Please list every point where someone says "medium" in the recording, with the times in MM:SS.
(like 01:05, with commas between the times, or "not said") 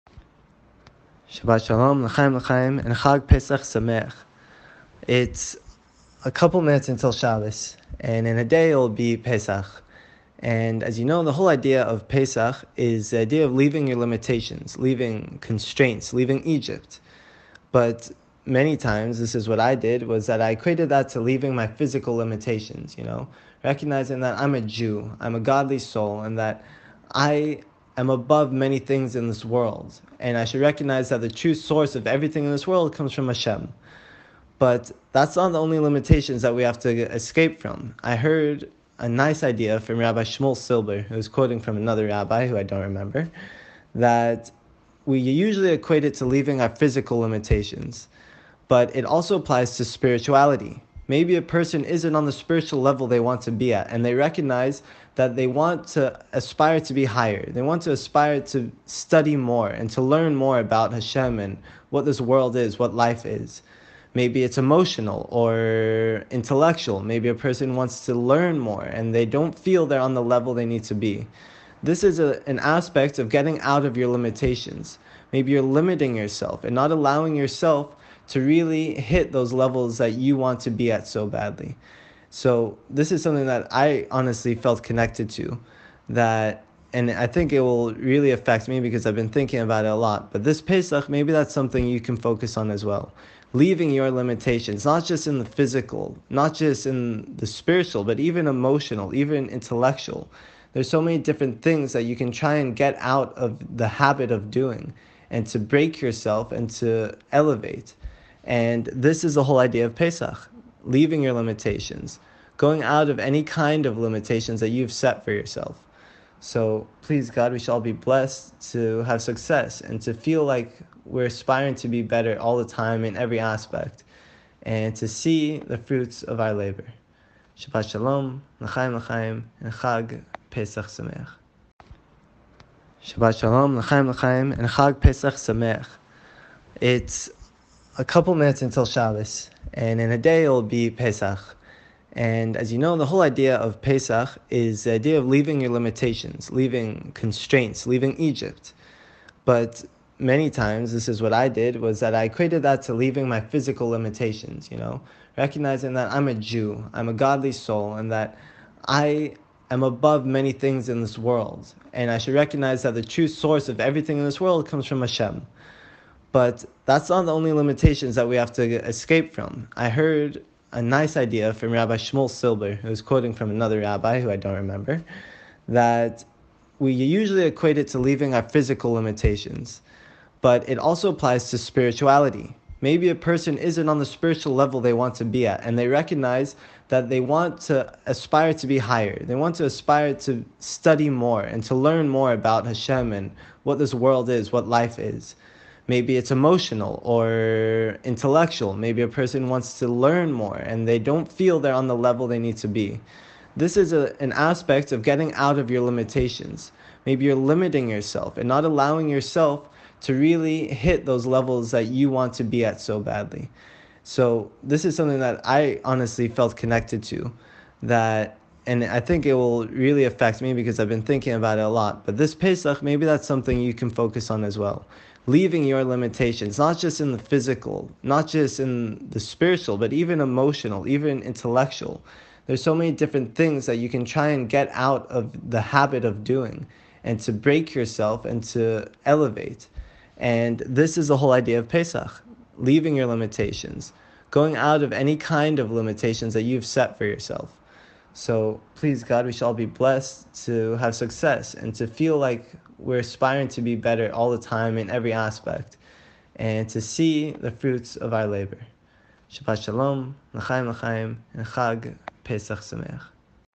not said.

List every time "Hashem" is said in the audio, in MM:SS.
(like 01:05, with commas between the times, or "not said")
00:33, 01:00, 02:45, 03:12.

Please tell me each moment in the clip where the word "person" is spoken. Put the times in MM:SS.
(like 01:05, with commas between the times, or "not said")
00:51, 01:07, 03:03, 03:19.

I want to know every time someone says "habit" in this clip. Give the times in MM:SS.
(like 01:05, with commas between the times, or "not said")
01:43, 03:55.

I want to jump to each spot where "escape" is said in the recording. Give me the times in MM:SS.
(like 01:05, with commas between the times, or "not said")
00:37, 02:48.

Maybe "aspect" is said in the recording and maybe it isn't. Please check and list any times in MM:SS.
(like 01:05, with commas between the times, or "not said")
01:12, 02:03, 03:24, 04:15.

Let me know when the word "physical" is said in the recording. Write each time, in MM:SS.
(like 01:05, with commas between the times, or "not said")
00:21, 00:46, 01:35, 02:33, 02:58, 03:47.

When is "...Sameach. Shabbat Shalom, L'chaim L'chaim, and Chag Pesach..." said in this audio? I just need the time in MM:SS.
02:10.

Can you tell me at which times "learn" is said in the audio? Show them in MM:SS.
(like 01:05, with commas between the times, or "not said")
01:00, 01:08, 03:11, 03:19.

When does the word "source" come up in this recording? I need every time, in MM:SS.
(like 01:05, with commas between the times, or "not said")
00:31, 02:43.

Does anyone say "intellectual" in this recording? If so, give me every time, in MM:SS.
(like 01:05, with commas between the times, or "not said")
01:06, 01:39, 03:18, 03:51.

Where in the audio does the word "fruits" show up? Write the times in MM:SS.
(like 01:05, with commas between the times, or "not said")
02:05, 04:17.